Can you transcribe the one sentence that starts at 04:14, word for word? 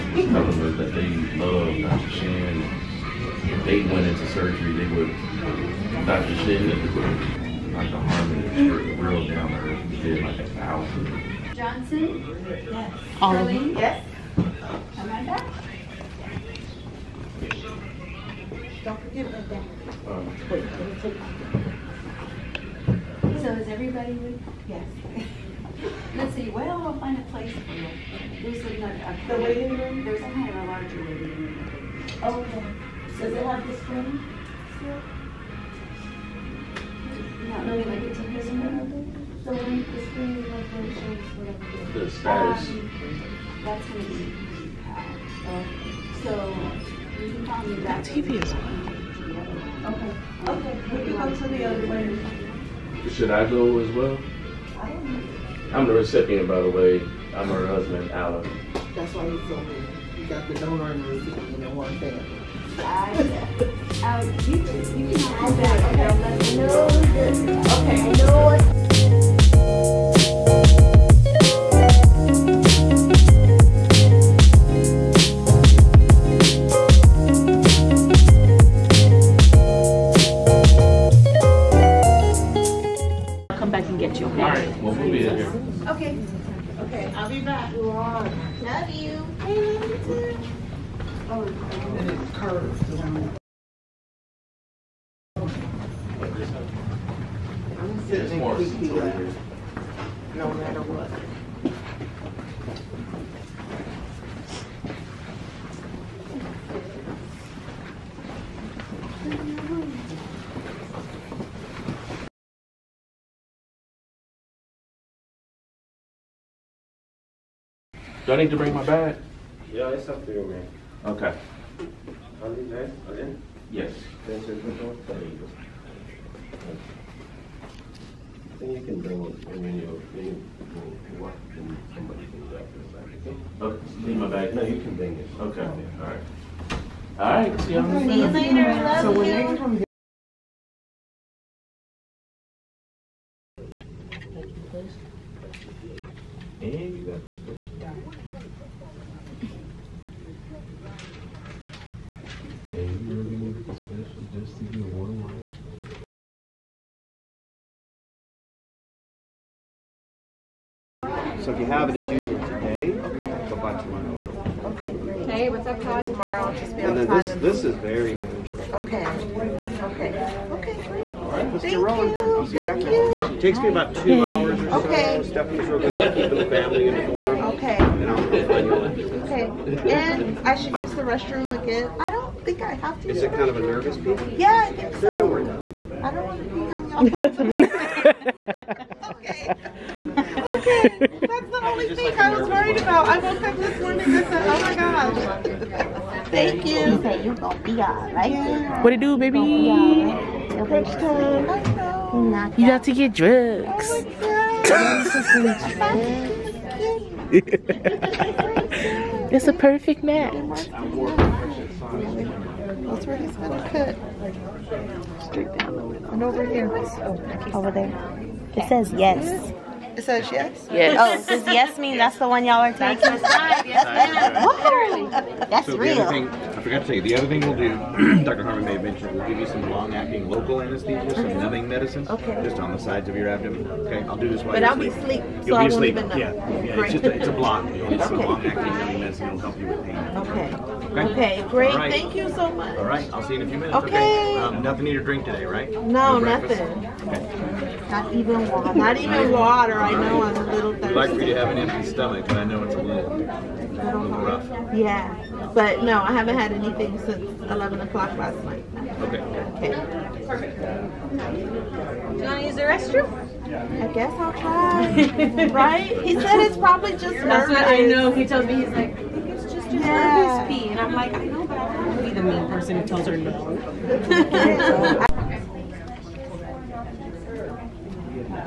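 Yeah, but no, I haven't had anything since 11 o'clock last night.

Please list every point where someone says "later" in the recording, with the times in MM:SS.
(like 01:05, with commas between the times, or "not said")
02:18.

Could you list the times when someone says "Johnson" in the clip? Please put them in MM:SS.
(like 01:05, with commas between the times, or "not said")
00:11.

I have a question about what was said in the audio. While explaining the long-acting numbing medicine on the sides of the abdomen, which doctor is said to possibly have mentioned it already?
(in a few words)
Dr. Harmon.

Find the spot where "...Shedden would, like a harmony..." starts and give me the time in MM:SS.
00:06.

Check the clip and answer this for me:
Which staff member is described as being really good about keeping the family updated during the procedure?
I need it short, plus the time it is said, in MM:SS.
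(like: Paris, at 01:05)
Stephanie, at 02:55.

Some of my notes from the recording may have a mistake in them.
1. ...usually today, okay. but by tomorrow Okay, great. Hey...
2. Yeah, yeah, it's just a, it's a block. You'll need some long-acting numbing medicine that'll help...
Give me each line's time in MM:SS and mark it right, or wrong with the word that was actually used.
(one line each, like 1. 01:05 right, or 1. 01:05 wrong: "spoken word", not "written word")
1. 02:42 right
2. 03:56 right.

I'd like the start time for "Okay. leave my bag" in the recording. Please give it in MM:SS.
02:13.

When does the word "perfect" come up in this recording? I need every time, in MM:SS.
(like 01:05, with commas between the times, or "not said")
03:29, 04:20.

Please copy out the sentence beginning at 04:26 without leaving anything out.
He said it's probably just That's nervous.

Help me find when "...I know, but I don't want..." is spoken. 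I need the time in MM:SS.
04:31.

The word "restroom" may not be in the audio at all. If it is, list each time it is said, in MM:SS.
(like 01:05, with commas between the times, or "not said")
03:01, 04:22.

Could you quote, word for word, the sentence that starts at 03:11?
That's the only thing I was worried about.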